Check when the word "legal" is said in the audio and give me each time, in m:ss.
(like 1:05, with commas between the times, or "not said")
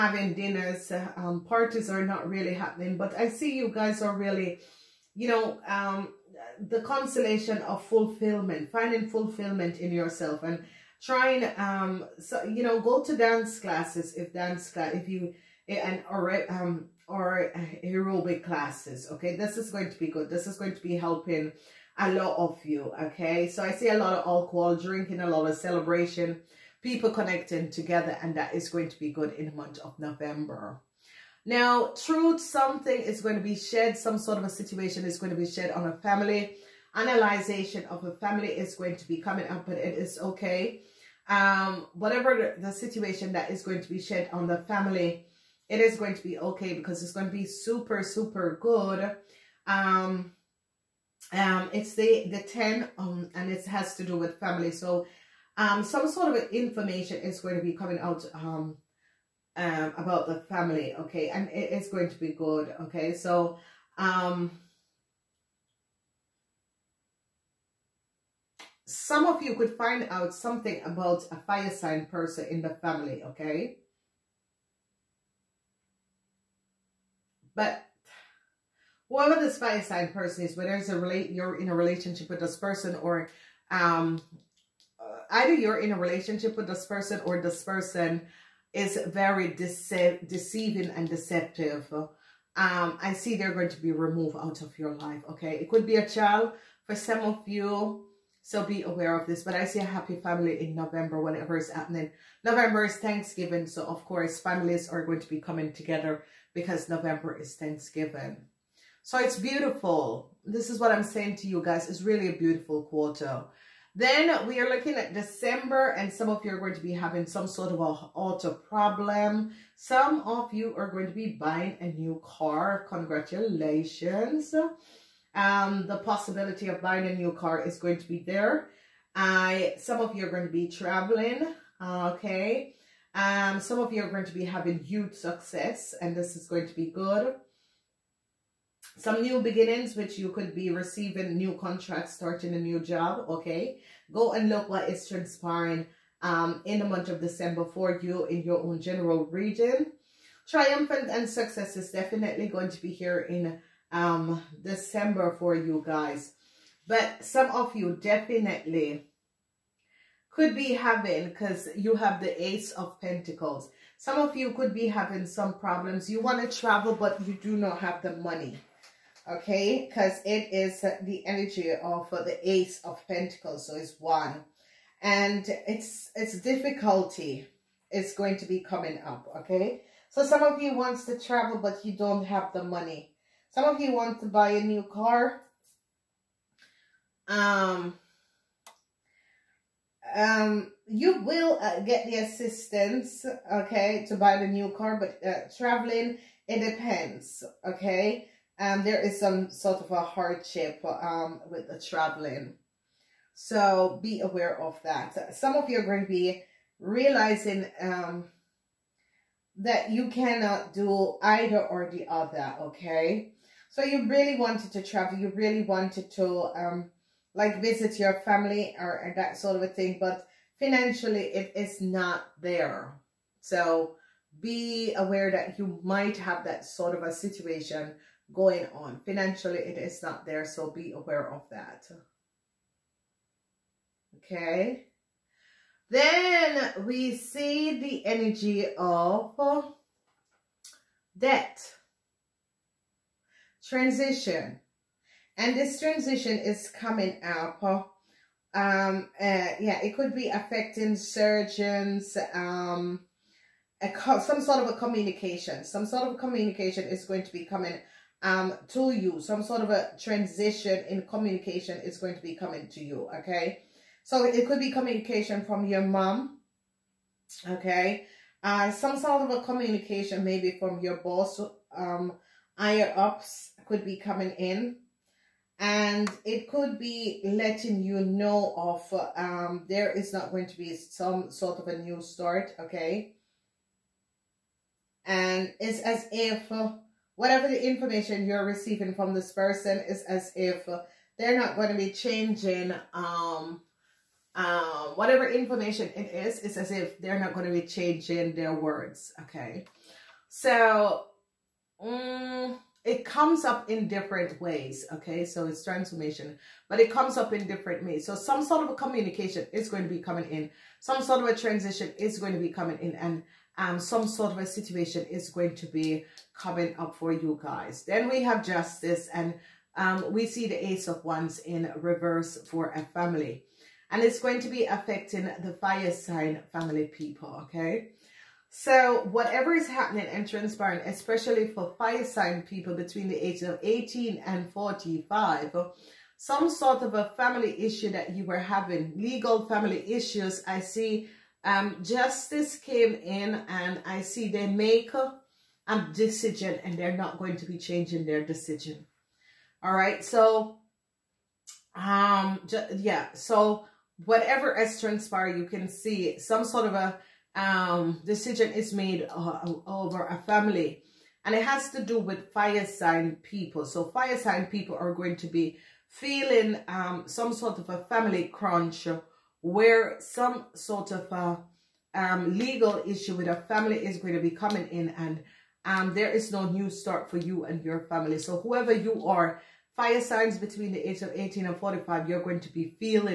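5:38, 6:12.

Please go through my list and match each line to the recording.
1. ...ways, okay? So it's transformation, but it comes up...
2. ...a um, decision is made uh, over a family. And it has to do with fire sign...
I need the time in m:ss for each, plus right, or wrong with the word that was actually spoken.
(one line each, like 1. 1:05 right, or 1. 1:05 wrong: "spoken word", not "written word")
1. 5:04 right
2. 5:56 right.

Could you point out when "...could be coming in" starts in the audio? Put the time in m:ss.
4:33.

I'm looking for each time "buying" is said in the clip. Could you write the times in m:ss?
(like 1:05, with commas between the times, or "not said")
2:01, 2:06.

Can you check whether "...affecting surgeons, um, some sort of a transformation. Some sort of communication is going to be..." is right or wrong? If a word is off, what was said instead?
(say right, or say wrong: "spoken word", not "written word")
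wrong: "communication", not "transformation".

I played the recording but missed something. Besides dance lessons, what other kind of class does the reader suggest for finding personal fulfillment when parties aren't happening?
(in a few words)
aerobic classes.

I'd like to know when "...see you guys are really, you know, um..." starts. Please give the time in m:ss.
0:03.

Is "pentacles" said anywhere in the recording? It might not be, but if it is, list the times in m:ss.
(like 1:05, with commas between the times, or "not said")
2:42, 2:53.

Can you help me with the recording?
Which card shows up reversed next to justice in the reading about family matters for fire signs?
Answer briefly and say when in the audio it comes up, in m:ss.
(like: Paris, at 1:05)
ace of wands, at 5:20.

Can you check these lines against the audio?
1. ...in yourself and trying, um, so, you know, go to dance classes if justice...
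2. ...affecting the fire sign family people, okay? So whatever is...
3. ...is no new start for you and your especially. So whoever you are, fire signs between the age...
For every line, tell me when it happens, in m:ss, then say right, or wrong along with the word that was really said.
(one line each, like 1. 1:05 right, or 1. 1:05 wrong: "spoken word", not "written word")
1. 0:09 wrong: "dance", not "justice"
2. 5:24 right
3. 6:16 wrong: "family", not "especially".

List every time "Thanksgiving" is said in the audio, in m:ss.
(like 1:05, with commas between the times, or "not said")
1:42, 1:47.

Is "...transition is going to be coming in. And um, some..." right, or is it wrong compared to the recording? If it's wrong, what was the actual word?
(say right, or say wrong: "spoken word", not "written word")
right.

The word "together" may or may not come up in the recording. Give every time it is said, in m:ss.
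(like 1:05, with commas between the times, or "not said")
0:27, 1:45.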